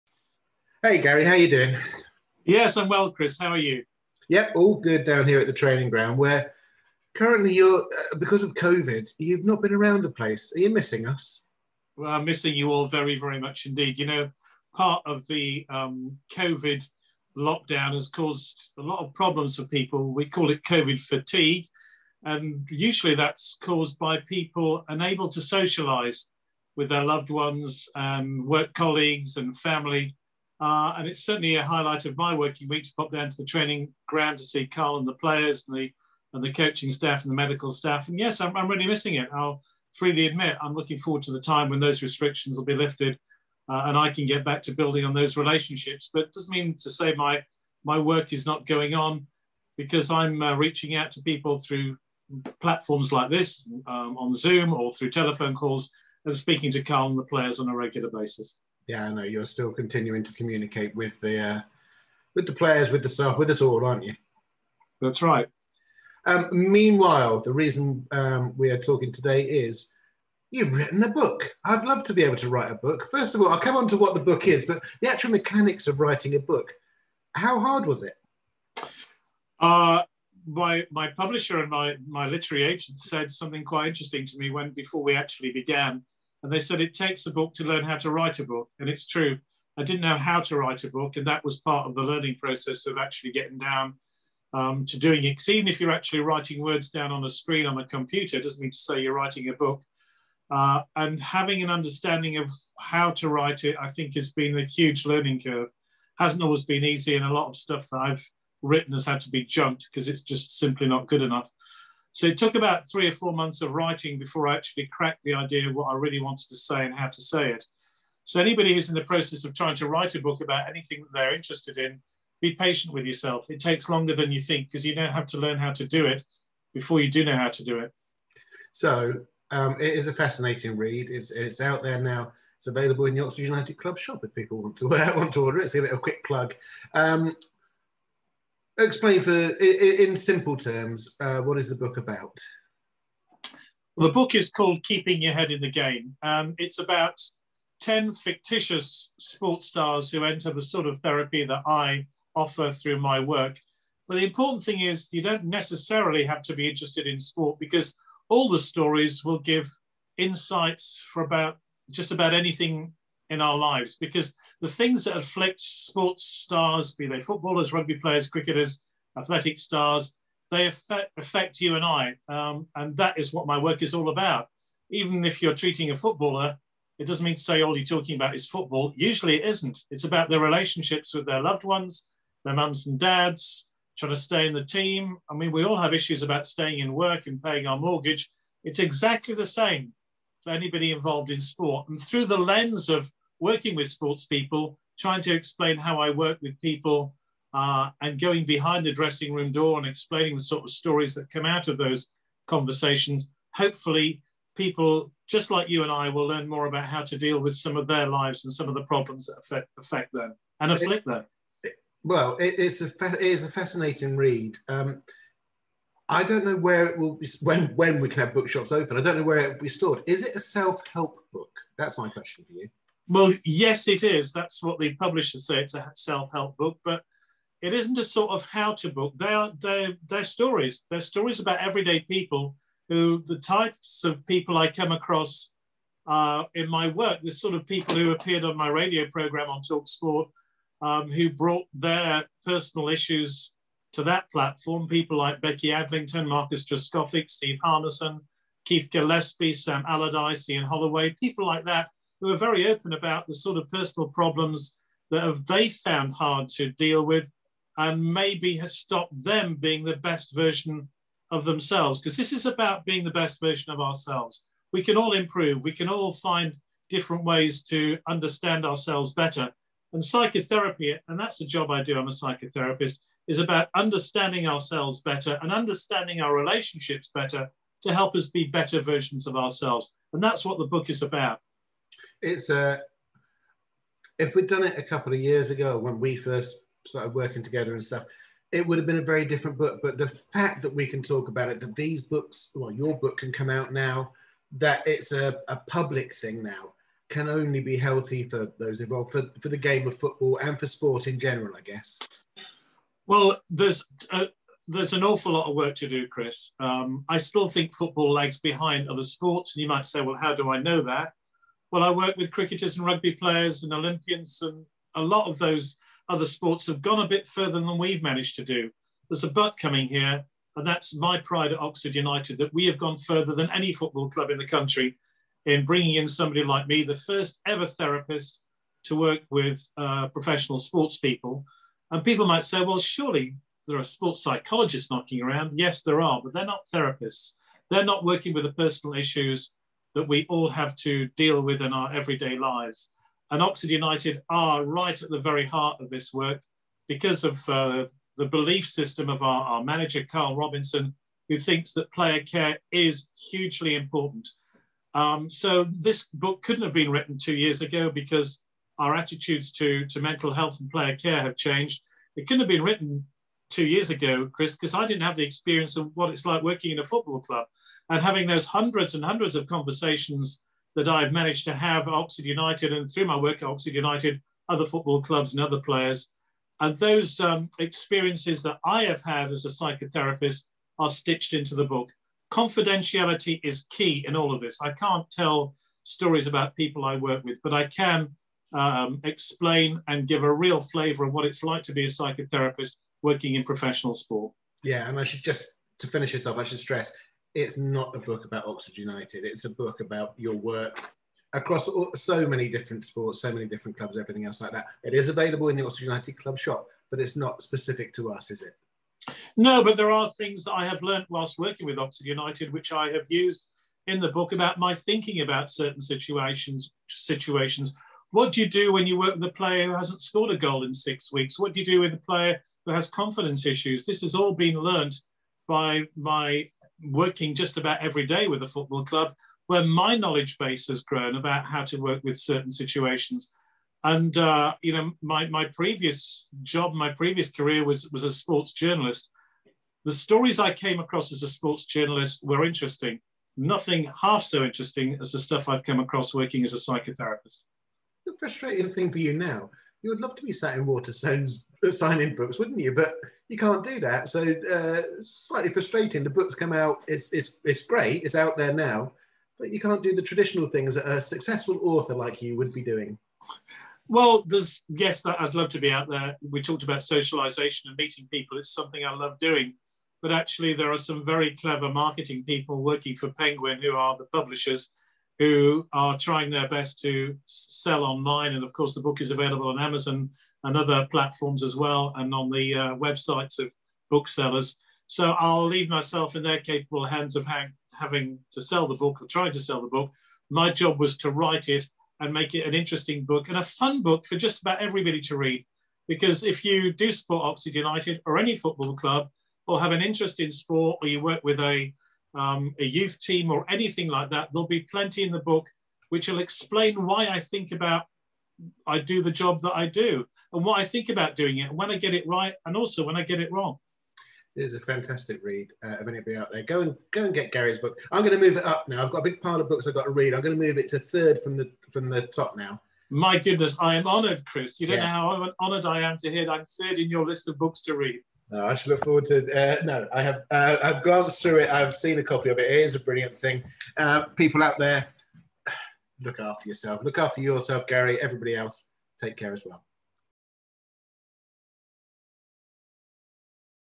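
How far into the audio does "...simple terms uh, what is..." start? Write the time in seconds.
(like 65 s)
140 s.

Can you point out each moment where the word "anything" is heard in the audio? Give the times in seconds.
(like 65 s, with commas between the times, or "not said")
120 s, 162 s, 503 s.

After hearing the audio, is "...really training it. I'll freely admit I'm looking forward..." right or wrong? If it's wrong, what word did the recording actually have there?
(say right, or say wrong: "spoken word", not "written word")
wrong: "missing", not "training".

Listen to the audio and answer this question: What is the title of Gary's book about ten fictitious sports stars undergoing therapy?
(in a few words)
Keeping Your Head in the Game.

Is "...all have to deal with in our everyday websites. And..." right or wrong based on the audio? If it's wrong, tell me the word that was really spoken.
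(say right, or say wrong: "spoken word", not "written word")
wrong: "lives", not "websites".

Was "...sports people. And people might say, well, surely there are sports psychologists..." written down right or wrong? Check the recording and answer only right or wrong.
right.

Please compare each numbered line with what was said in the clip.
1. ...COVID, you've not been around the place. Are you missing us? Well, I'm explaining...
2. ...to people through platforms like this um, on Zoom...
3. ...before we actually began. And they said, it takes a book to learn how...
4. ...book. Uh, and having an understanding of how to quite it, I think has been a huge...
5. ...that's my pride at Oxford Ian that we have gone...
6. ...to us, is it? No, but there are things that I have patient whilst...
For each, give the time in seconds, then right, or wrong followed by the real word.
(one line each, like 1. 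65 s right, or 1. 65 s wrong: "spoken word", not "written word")
1. 8 s wrong: "missing", not "explaining"
2. 51 s right
3. 84 s right
4. 99 s wrong: "write", not "quite"
5. 320 s wrong: "United", not "Ian"
6. 407 s wrong: "learnt", not "patient".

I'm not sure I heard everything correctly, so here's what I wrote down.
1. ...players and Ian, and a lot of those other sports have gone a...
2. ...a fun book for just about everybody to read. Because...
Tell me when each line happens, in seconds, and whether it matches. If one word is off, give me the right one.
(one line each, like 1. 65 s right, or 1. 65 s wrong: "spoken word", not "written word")
1. 313 s wrong: "Olympians", not "Ian"
2. 493 s right.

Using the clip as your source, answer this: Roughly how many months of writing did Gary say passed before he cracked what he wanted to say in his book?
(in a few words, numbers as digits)
three or four.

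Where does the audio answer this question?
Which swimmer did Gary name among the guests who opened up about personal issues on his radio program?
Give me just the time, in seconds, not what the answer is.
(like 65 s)
245 s.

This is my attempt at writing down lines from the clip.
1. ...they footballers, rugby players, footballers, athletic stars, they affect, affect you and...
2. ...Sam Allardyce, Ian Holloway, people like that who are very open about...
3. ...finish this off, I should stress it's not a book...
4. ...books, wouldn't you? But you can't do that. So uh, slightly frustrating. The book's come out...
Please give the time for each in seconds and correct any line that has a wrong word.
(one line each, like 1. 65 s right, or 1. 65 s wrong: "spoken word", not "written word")
1. 167 s wrong: "cricketers", not "footballers"
2. 249 s right
3. 395 s right
4. 452 s right.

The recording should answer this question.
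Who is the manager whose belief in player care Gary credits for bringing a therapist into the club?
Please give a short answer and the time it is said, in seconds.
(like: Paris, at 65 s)
Karl Robinson, at 350 s.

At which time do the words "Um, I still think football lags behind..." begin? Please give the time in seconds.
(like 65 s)
306 s.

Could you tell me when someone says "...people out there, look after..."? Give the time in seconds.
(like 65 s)
534 s.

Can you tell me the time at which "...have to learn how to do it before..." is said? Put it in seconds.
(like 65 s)
125 s.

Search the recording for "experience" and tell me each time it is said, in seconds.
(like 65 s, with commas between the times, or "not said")
365 s, 377 s.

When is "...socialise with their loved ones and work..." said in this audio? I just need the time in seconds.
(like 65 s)
25 s.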